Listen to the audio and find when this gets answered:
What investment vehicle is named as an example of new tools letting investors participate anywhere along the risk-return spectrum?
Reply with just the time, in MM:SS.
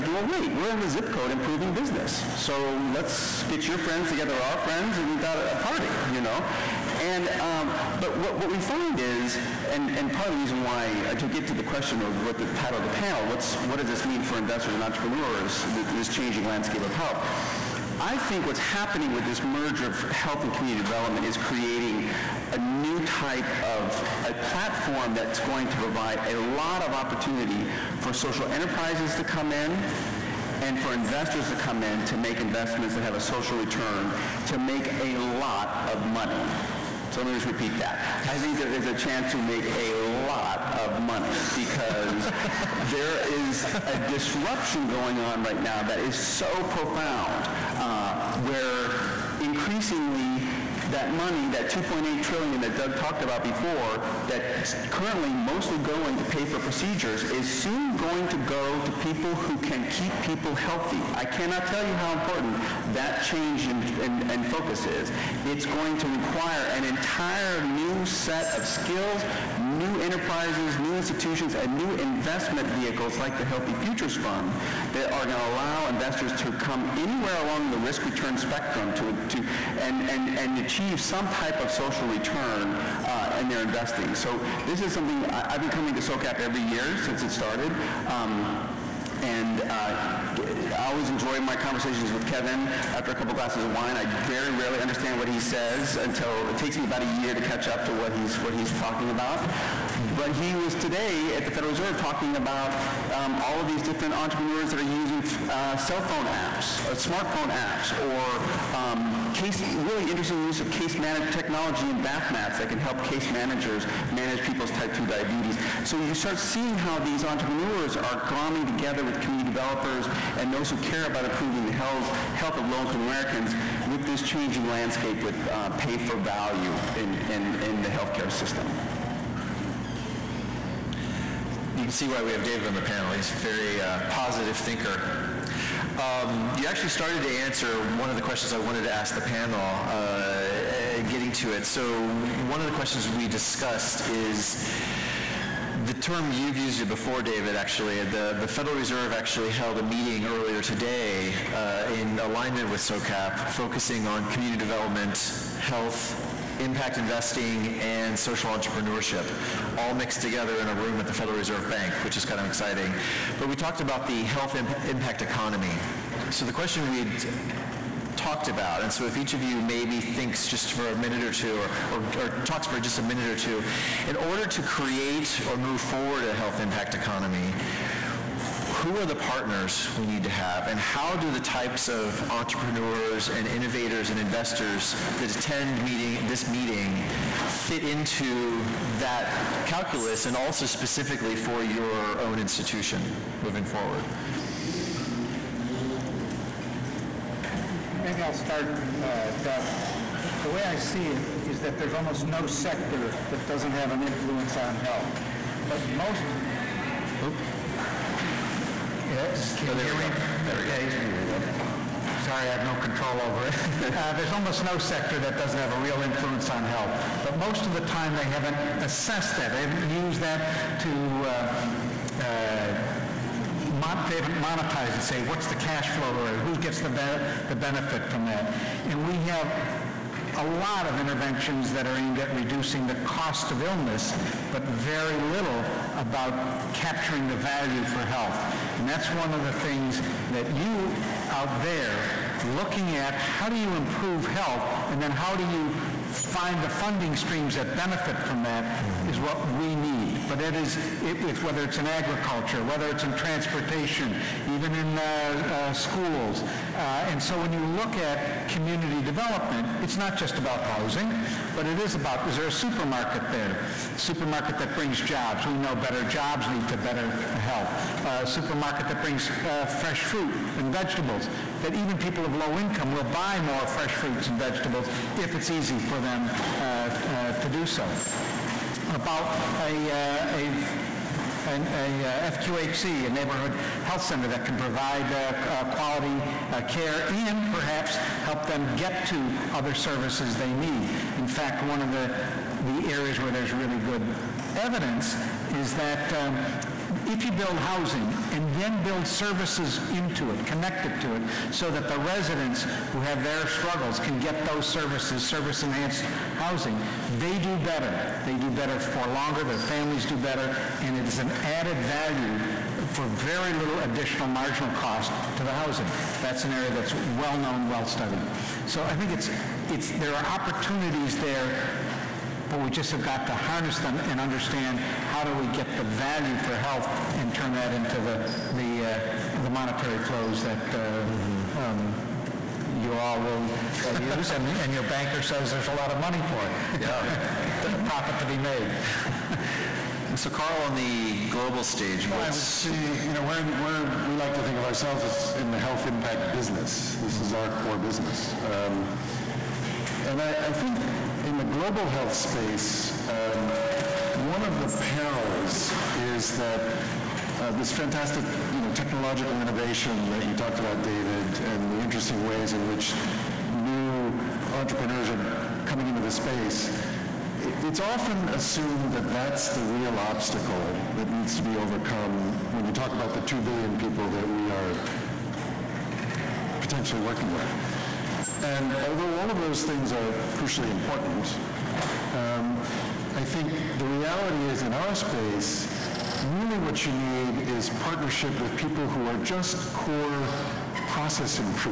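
01:13.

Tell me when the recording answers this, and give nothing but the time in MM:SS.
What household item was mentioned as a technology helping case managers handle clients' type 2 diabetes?
01:52.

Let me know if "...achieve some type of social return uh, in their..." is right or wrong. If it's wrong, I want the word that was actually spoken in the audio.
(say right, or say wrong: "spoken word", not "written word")
right.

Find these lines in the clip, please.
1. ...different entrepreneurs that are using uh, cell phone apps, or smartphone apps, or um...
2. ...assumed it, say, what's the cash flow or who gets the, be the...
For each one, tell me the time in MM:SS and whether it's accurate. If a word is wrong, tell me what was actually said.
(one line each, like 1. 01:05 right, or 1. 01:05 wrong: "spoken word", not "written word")
1. 01:43 right
2. 03:44 wrong: "monetized", not "assumed".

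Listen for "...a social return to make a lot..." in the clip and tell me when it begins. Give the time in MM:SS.
00:33.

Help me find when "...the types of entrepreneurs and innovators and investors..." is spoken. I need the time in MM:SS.
03:01.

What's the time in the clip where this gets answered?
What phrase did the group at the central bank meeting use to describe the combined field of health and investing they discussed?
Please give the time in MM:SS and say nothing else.
02:44.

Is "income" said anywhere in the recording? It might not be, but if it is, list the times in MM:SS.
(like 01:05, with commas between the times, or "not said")
02:02, 04:32.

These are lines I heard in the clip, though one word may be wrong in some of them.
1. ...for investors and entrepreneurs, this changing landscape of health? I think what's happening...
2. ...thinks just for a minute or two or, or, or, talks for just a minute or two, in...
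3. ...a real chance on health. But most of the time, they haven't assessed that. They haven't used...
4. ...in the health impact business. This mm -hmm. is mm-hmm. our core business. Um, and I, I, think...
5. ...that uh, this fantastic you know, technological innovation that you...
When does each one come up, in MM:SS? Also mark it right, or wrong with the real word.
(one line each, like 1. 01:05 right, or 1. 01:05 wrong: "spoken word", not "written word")
1. 00:14 right
2. 02:50 right
3. 03:35 wrong: "influence", not "chance"
4. 05:45 right
5. 05:56 right.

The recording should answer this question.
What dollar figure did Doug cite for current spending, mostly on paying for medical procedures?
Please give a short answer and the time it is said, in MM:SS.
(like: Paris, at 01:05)
2.8 trillion, at 00:51.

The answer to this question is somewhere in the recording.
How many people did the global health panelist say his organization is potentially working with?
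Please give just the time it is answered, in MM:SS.
06:13.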